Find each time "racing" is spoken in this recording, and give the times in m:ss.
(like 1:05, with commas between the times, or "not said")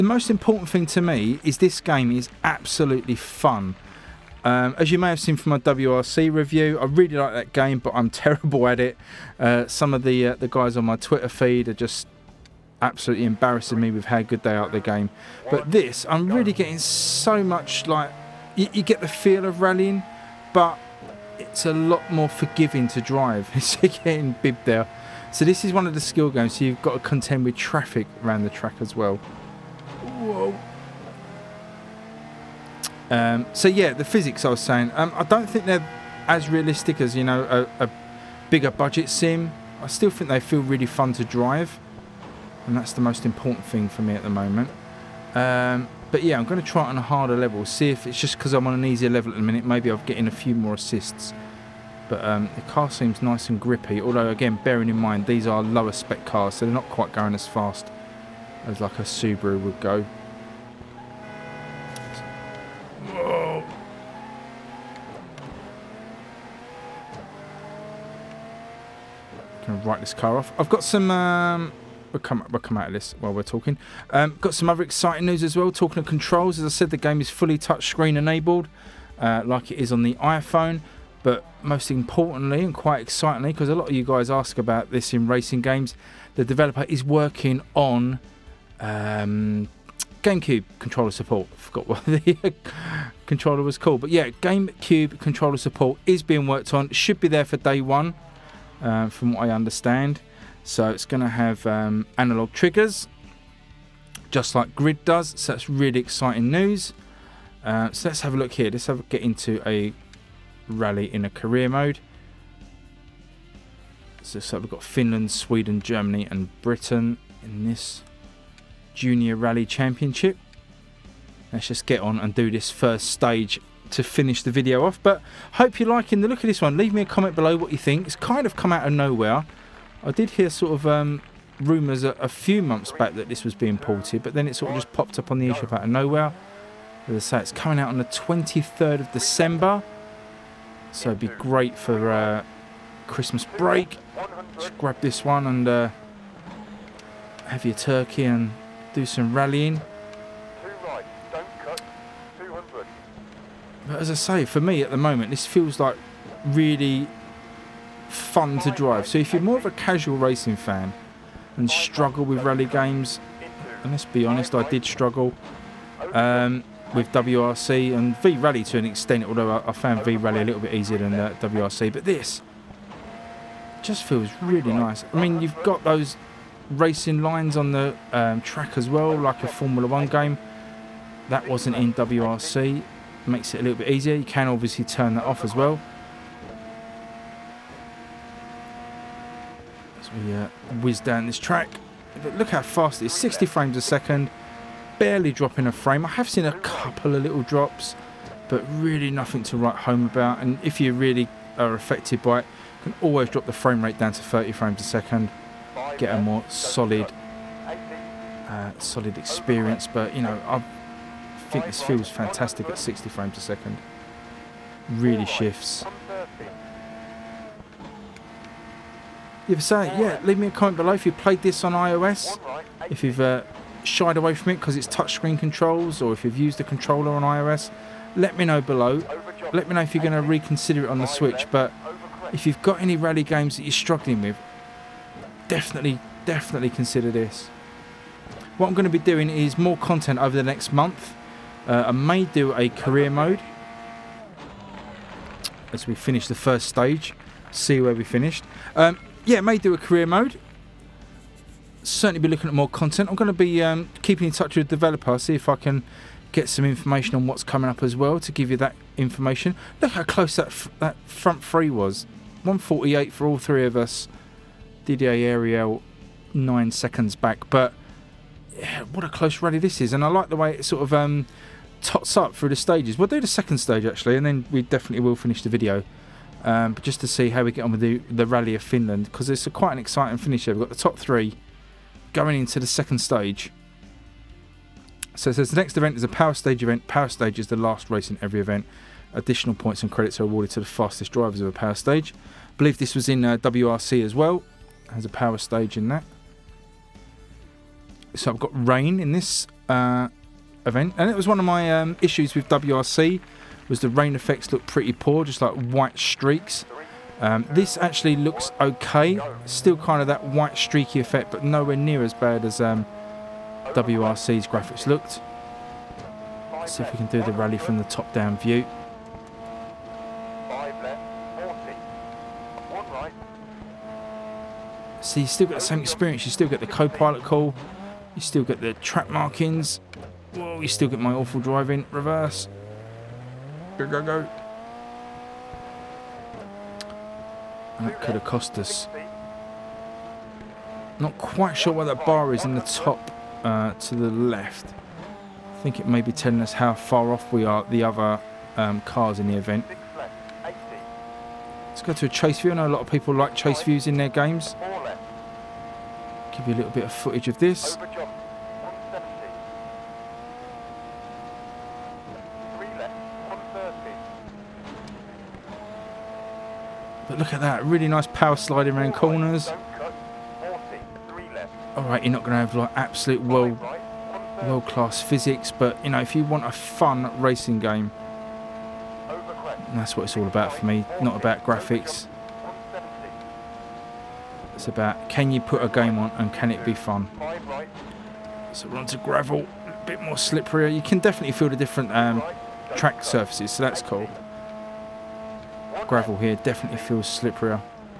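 1:25, 2:40, 2:56, 6:17.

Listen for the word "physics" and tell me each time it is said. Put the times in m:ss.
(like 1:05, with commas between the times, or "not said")
0:34, 6:15.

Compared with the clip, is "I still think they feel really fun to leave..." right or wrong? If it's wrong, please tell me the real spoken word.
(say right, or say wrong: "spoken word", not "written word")
wrong: "drive", not "leave".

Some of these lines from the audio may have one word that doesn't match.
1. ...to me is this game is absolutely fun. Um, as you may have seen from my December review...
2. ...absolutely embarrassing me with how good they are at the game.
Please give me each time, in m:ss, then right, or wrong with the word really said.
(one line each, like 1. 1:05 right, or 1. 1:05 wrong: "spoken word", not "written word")
1. 0:00 wrong: "WRC", not "December"
2. 0:12 right.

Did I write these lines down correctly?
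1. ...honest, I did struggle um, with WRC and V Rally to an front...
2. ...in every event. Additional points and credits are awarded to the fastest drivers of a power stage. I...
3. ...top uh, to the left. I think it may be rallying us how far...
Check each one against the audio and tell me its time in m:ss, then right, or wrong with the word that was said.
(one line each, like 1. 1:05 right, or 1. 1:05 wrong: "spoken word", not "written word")
1. 2:44 wrong: "extent", not "front"
2. 4:48 right
3. 5:42 wrong: "telling", not "rallying".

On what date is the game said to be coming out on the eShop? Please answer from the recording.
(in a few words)
23rd of December.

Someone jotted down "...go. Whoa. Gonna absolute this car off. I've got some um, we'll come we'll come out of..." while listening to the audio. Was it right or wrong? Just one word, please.
wrong.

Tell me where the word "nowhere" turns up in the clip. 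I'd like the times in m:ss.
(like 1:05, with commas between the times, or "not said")
2:08, 2:15, 5:11.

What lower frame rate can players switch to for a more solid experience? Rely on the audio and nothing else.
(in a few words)
30 frames a second.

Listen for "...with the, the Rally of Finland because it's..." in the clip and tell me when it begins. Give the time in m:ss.
4:37.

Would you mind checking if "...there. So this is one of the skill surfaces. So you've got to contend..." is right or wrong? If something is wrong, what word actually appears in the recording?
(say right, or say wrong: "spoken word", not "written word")
wrong: "games", not "surfaces".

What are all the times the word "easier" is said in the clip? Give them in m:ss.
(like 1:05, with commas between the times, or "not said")
0:48, 2:50, 3:03.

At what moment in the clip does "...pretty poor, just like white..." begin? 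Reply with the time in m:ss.
5:04.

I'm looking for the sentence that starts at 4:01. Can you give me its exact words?
Uh, I may do a career mode as we finish the first stage, see where we finished.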